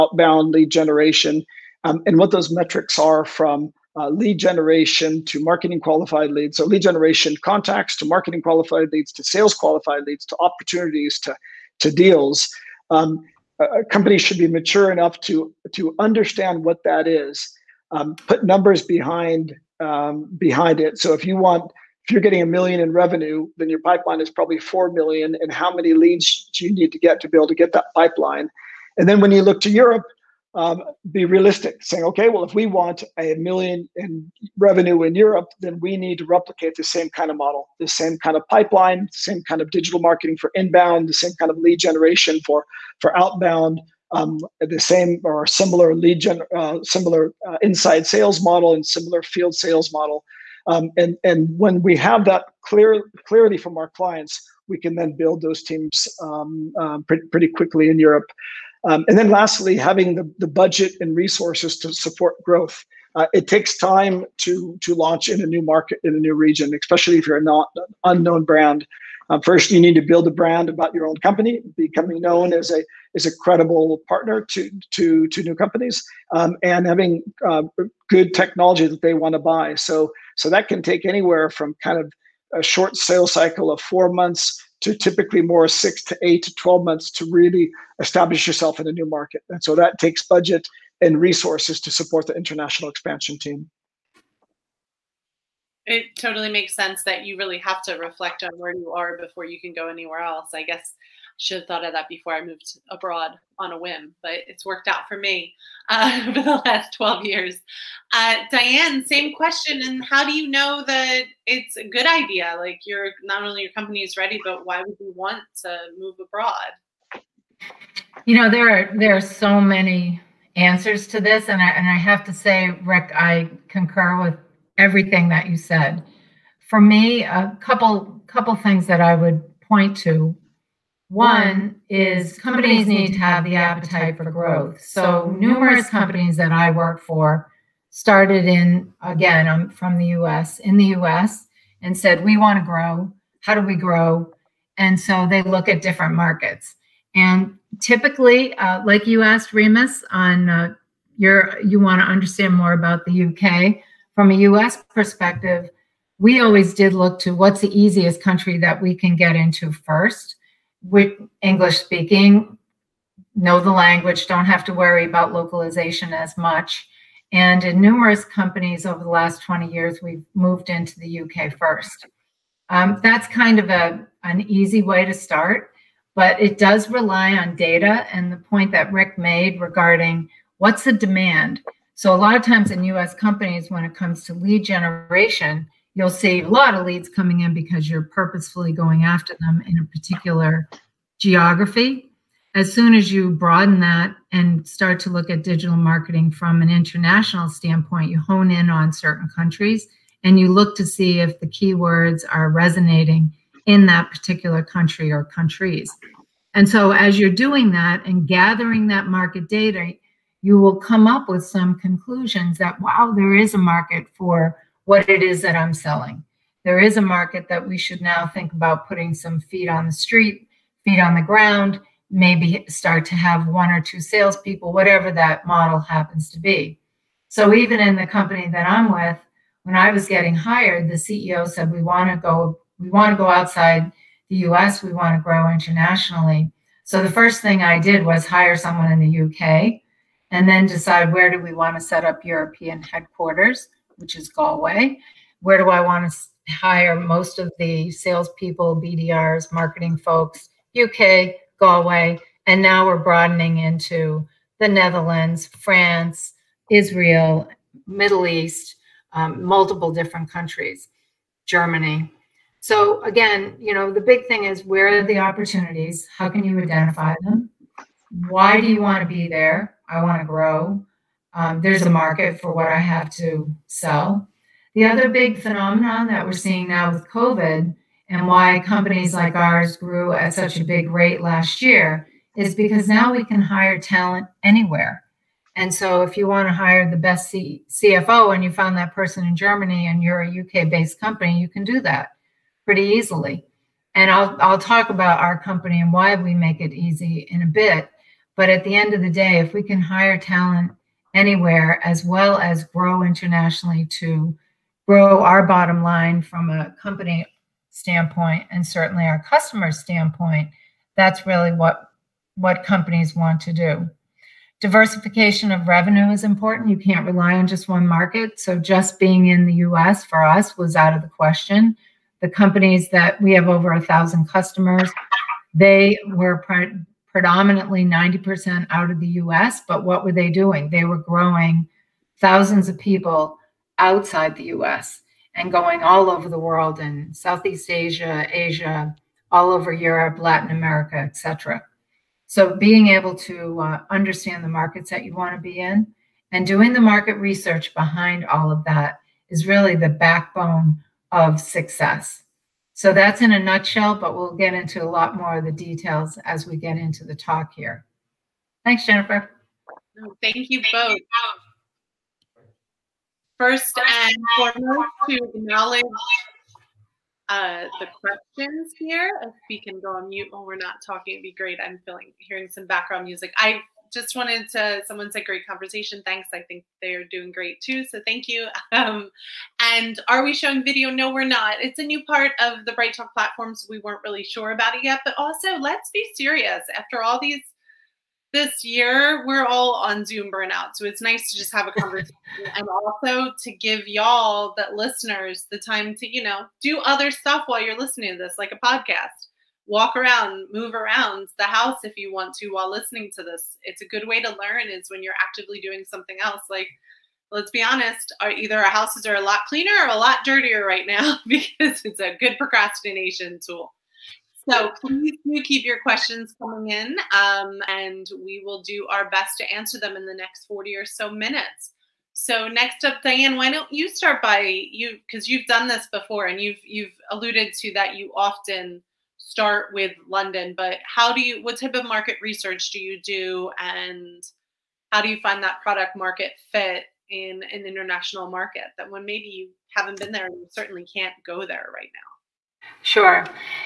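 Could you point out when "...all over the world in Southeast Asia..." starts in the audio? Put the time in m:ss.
5:35.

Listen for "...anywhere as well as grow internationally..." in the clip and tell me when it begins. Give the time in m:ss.
5:01.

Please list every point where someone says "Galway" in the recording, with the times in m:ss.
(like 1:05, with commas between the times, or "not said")
4:04, 4:11.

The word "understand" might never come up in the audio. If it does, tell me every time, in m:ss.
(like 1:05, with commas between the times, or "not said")
0:15, 2:32, 5:43.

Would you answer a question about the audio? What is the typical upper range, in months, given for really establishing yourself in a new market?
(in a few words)
12 months.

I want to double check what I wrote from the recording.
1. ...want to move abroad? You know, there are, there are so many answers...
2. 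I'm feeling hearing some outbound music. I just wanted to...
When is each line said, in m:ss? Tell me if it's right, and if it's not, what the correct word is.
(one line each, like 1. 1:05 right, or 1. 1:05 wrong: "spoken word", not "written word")
1. 1:55 right
2. 6:11 wrong: "background", not "outbound".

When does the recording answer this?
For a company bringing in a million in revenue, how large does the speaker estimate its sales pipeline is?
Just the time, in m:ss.
0:24.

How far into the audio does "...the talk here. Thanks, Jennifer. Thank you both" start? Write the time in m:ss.
5:57.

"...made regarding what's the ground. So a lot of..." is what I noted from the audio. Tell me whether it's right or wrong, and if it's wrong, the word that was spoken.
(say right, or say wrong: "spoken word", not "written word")
wrong: "demand", not "ground".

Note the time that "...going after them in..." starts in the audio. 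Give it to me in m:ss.
3:08.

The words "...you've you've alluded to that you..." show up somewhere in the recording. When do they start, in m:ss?
7:06.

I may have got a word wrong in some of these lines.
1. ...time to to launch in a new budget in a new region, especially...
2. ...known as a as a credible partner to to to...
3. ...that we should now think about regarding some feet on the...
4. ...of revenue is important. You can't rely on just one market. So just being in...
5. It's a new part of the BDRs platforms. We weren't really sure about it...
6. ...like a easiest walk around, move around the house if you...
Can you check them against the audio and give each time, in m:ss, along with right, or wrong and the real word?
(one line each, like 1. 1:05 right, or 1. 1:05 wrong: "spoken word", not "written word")
1. 1:03 wrong: "market", not "budget"
2. 1:12 right
3. 3:37 wrong: "putting", not "regarding"
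4. 5:15 right
5. 6:21 wrong: "BrightTALK", not "BDRs"
6. 6:38 wrong: "podcast", not "easiest".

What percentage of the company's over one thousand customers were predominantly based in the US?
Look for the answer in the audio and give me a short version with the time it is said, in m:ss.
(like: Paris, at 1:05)
90%, at 5:27.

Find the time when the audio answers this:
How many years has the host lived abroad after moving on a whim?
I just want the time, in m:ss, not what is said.
1:46.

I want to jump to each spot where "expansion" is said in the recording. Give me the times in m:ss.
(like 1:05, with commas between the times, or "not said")
1:32.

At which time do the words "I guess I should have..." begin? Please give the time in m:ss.
1:40.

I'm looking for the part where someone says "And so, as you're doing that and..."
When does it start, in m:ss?
3:26.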